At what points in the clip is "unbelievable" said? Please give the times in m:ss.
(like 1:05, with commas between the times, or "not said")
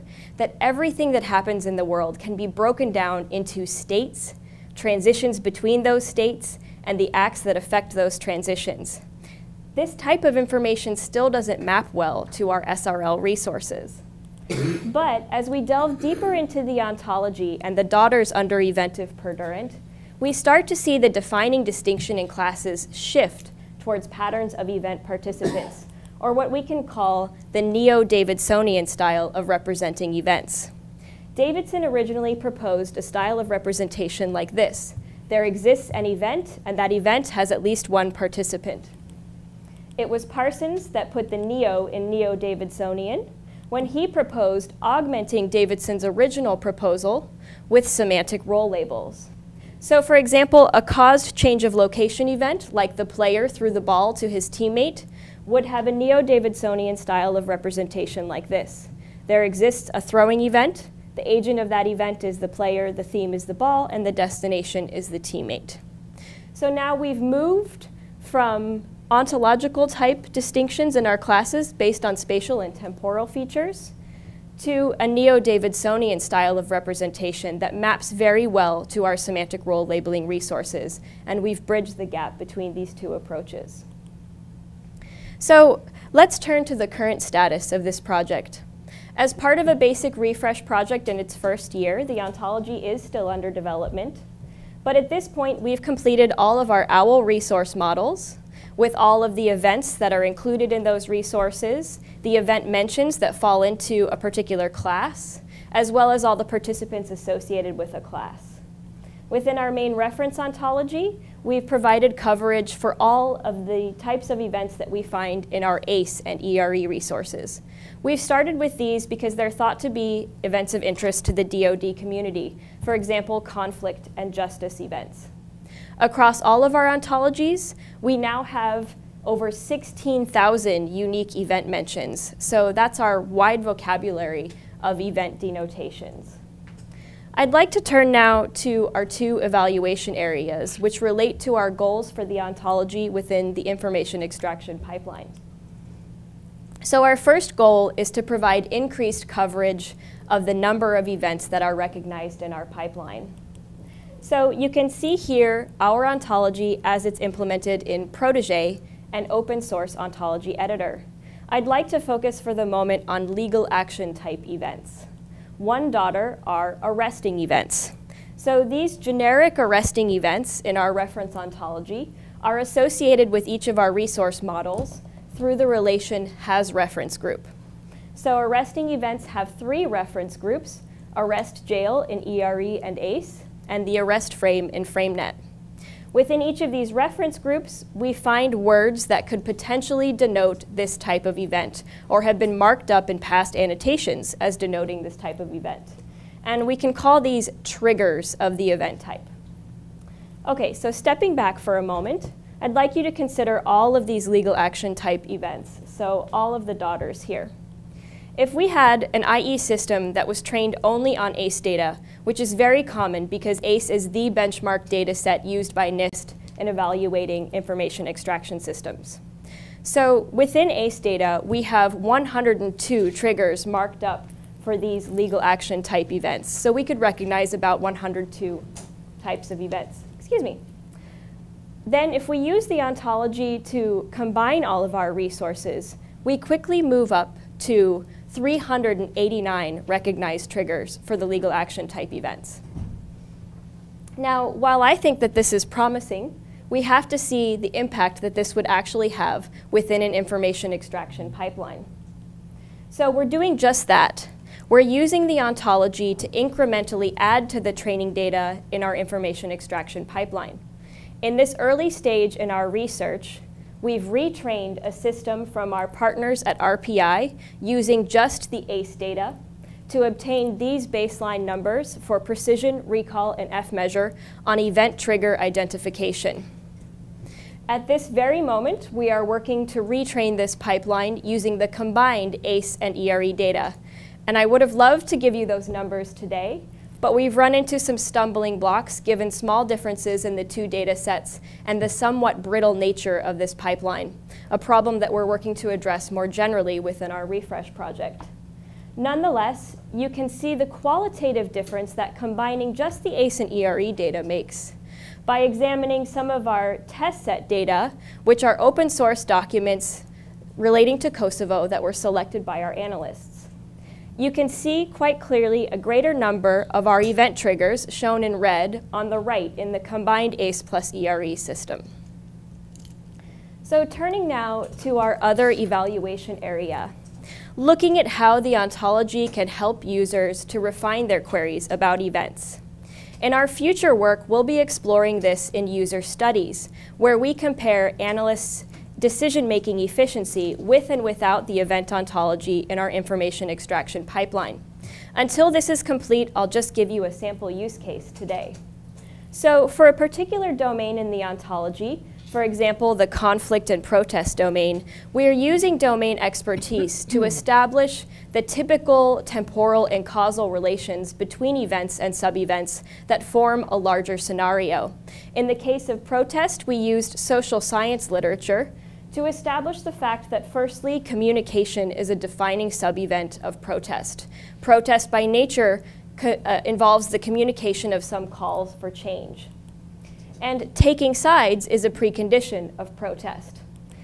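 not said.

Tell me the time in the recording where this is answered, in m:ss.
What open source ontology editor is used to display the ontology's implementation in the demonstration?
2:38.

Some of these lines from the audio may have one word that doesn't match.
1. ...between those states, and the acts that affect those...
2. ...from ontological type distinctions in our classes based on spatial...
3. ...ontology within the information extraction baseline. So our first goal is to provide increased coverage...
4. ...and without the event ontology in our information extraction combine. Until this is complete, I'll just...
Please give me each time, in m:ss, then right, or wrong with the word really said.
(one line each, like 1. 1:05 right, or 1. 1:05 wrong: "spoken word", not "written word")
1. 0:05 right
2. 1:08 right
3. 2:22 wrong: "pipeline", not "baseline"
4. 5:40 wrong: "pipeline", not "combine".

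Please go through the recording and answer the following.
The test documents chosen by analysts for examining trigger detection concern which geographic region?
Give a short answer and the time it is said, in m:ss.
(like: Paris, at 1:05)
Kosovo, at 5:11.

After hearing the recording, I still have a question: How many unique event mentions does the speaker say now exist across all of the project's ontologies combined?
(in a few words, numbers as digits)
16,000.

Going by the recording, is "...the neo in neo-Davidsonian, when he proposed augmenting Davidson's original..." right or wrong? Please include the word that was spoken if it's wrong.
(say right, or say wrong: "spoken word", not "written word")
right.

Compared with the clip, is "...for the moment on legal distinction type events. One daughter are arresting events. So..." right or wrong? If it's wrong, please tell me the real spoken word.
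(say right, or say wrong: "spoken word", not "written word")
wrong: "action", not "distinction".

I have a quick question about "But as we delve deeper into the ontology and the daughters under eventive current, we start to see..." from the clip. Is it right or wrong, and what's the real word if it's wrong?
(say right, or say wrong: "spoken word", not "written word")
wrong: "perdurant", not "current".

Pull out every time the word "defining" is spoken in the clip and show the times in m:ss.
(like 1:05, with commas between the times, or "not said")
0:21, 6:12.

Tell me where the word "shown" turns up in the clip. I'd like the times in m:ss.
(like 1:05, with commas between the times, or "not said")
5:17.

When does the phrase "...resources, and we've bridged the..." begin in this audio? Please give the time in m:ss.
1:20.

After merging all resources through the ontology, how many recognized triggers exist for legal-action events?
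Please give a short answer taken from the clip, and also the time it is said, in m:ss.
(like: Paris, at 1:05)
389, at 3:58.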